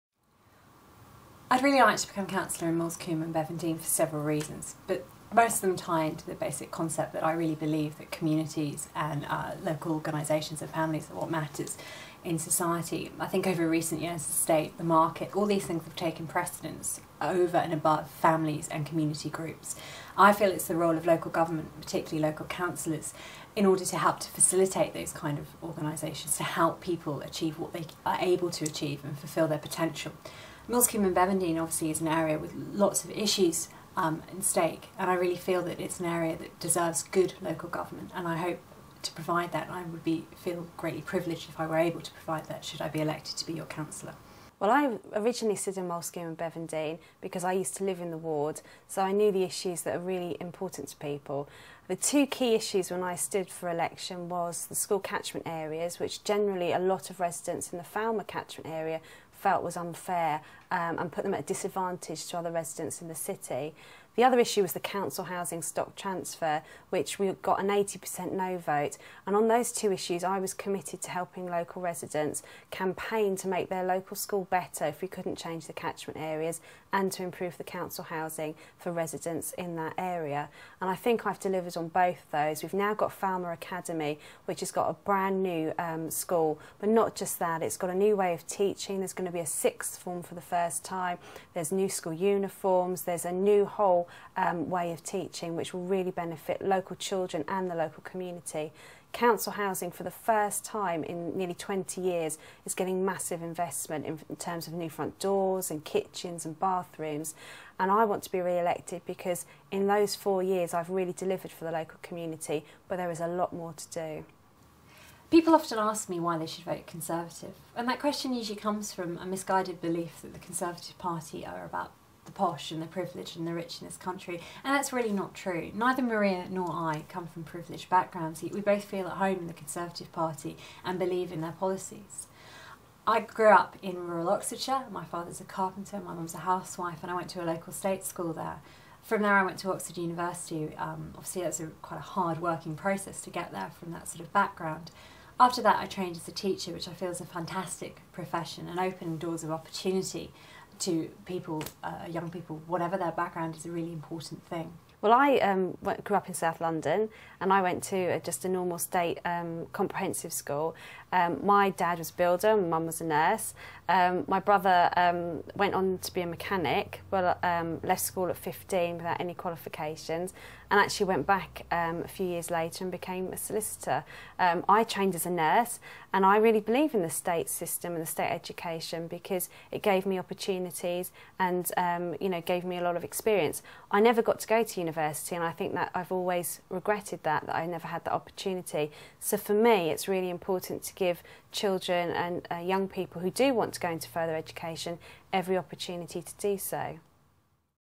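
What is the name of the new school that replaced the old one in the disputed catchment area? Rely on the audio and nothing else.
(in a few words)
Falmer Academy.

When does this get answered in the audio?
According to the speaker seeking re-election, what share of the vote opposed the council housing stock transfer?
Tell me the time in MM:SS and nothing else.
01:07.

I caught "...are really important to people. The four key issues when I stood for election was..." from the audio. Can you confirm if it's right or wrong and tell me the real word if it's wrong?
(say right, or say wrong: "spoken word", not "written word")
wrong: "two", not "four".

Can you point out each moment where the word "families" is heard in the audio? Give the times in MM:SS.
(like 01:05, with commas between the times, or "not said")
00:10, 00:18.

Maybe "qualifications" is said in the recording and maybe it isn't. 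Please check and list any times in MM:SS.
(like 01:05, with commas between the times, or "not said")
02:49.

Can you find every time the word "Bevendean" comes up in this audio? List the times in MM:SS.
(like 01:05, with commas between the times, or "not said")
00:03, 00:31, 00:46.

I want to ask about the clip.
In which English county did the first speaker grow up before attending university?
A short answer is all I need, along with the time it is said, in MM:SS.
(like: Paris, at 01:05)
Oxfordshire, at 02:14.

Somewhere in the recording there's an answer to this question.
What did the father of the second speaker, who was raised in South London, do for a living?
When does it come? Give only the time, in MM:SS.
02:42.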